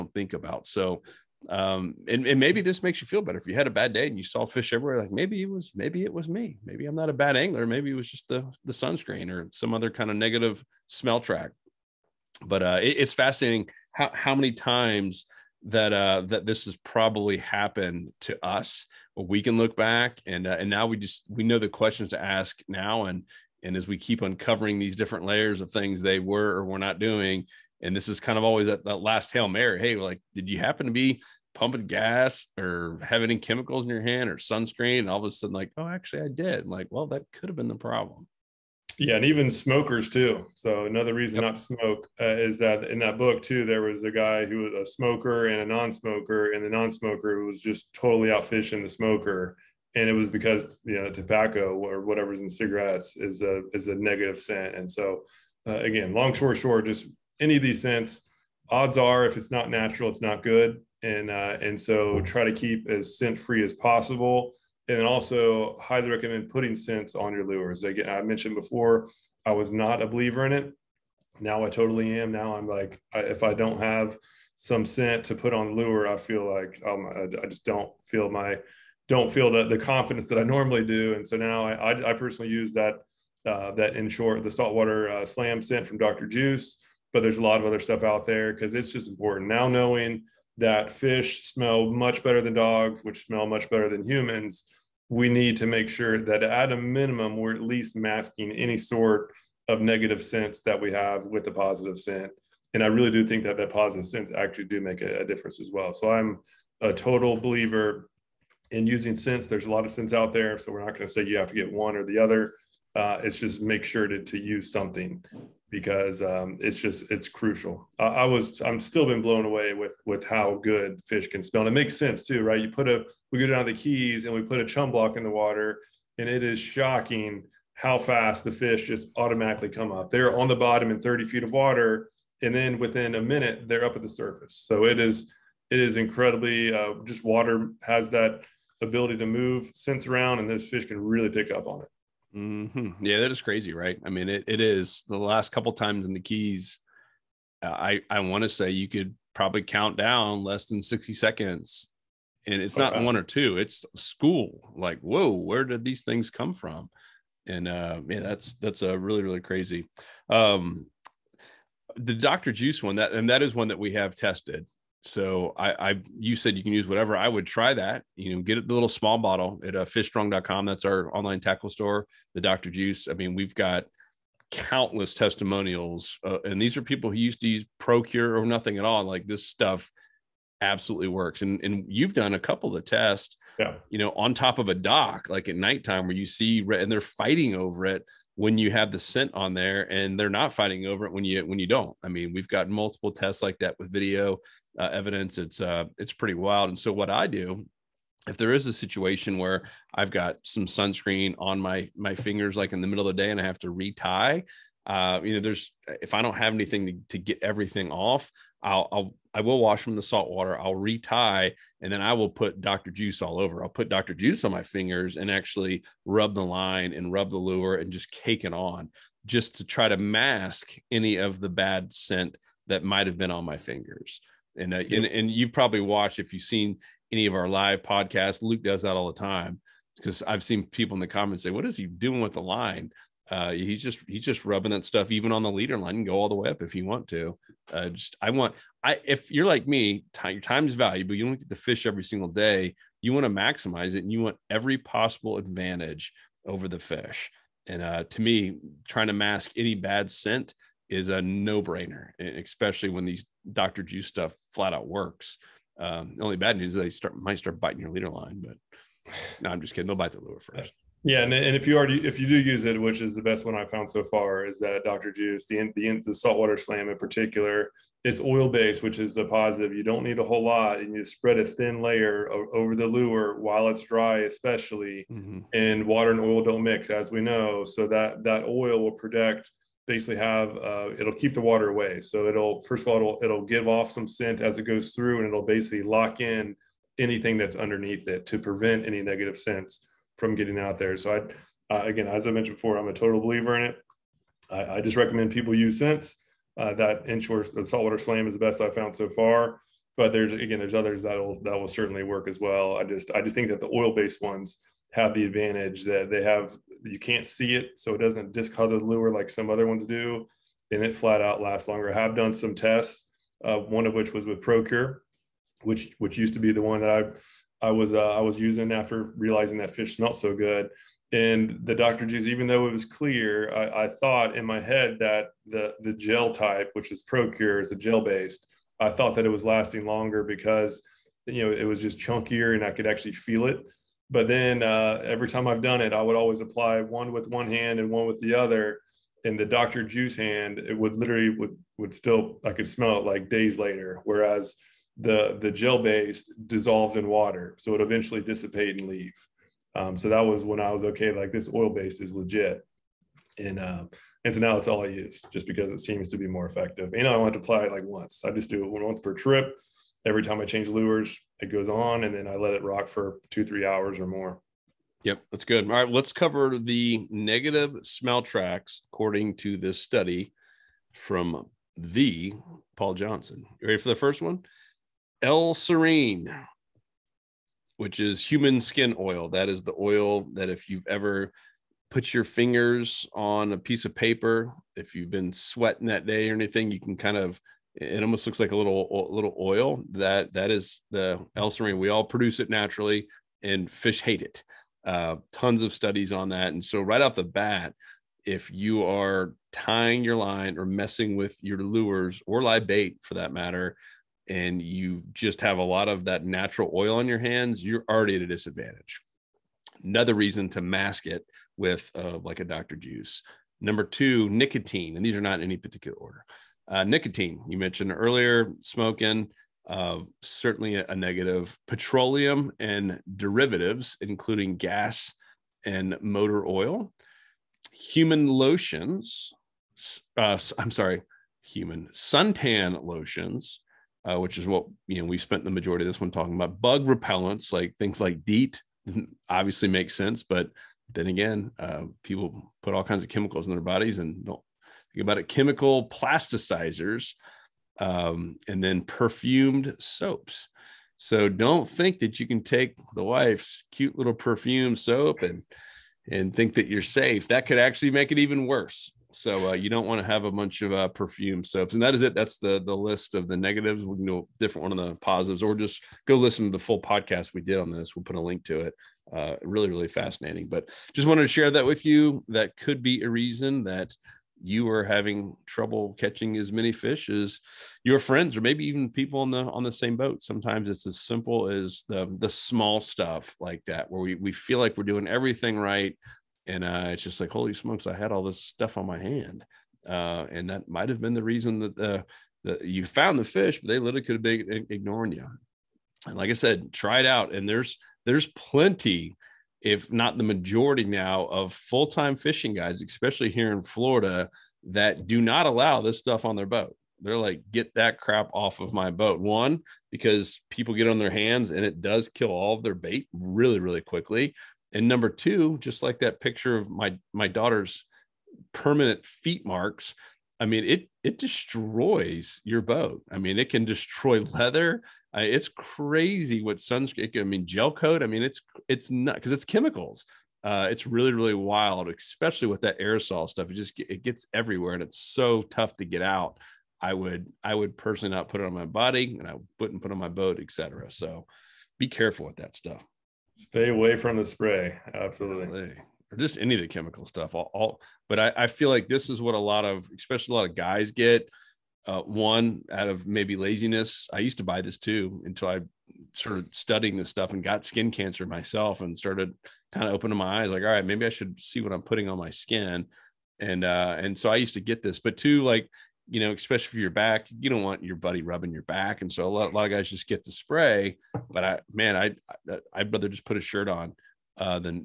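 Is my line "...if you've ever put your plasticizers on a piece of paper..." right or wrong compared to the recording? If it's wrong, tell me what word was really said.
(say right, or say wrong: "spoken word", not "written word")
wrong: "fingers", not "plasticizers".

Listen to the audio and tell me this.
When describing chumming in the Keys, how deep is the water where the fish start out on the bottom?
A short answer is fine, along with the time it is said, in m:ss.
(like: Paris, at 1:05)
30 feet, at 2:10.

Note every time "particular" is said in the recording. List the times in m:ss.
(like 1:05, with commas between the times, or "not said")
4:26, 6:55.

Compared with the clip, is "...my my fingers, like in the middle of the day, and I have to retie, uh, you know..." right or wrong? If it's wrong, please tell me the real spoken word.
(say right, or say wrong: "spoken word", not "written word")
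right.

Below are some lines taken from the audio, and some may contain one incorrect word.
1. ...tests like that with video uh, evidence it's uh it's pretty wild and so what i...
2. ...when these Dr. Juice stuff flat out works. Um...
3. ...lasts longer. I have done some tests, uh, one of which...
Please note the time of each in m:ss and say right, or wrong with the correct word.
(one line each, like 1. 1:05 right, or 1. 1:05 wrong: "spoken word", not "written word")
1. 3:13 right
2. 4:12 right
3. 5:11 right.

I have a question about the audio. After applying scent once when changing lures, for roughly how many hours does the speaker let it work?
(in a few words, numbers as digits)
2 to 3 hours.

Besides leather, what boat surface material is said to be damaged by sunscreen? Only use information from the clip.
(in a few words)
gel coat.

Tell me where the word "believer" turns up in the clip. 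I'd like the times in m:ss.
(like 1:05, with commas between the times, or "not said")
1:10, 1:47, 4:53.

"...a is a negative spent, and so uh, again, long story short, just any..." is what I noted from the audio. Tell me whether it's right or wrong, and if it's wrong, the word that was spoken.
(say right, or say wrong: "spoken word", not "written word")
wrong: "scent", not "spent".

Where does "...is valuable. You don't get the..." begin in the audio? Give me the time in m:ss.
4:00.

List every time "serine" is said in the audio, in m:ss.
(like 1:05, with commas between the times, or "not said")
6:15, 6:31.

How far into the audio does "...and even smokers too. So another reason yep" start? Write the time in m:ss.
0:39.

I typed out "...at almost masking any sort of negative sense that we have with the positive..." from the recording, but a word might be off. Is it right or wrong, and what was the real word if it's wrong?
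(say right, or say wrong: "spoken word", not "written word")
wrong: "least", not "almost".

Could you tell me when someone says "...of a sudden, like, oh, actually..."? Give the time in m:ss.
0:35.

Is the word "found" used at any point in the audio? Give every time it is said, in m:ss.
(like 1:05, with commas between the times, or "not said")
4:23, 4:58, 8:12.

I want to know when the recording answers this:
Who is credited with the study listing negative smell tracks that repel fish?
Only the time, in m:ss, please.
6:12.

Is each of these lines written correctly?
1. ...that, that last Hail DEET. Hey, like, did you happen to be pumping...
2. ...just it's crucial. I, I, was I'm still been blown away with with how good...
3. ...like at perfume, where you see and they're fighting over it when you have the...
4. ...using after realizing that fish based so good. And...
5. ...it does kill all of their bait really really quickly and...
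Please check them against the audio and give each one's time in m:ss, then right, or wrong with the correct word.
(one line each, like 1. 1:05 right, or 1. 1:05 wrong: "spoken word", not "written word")
1. 0:28 wrong: "Mary", not "DEET"
2. 1:56 right
3. 3:05 wrong: "nighttime", not "perfume"
4. 5:18 wrong: "smelled", not "based"
5. 8:31 right.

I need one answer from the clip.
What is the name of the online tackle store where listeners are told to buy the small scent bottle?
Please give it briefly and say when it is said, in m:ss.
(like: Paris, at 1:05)
fishstrong.com, at 2:49.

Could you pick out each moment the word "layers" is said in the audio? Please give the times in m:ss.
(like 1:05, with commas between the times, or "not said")
0:25, 4:31.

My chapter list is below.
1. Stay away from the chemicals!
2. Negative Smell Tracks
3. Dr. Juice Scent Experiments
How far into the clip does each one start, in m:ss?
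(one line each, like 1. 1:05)
1. 8:57
2. 6:02
3. 0:37.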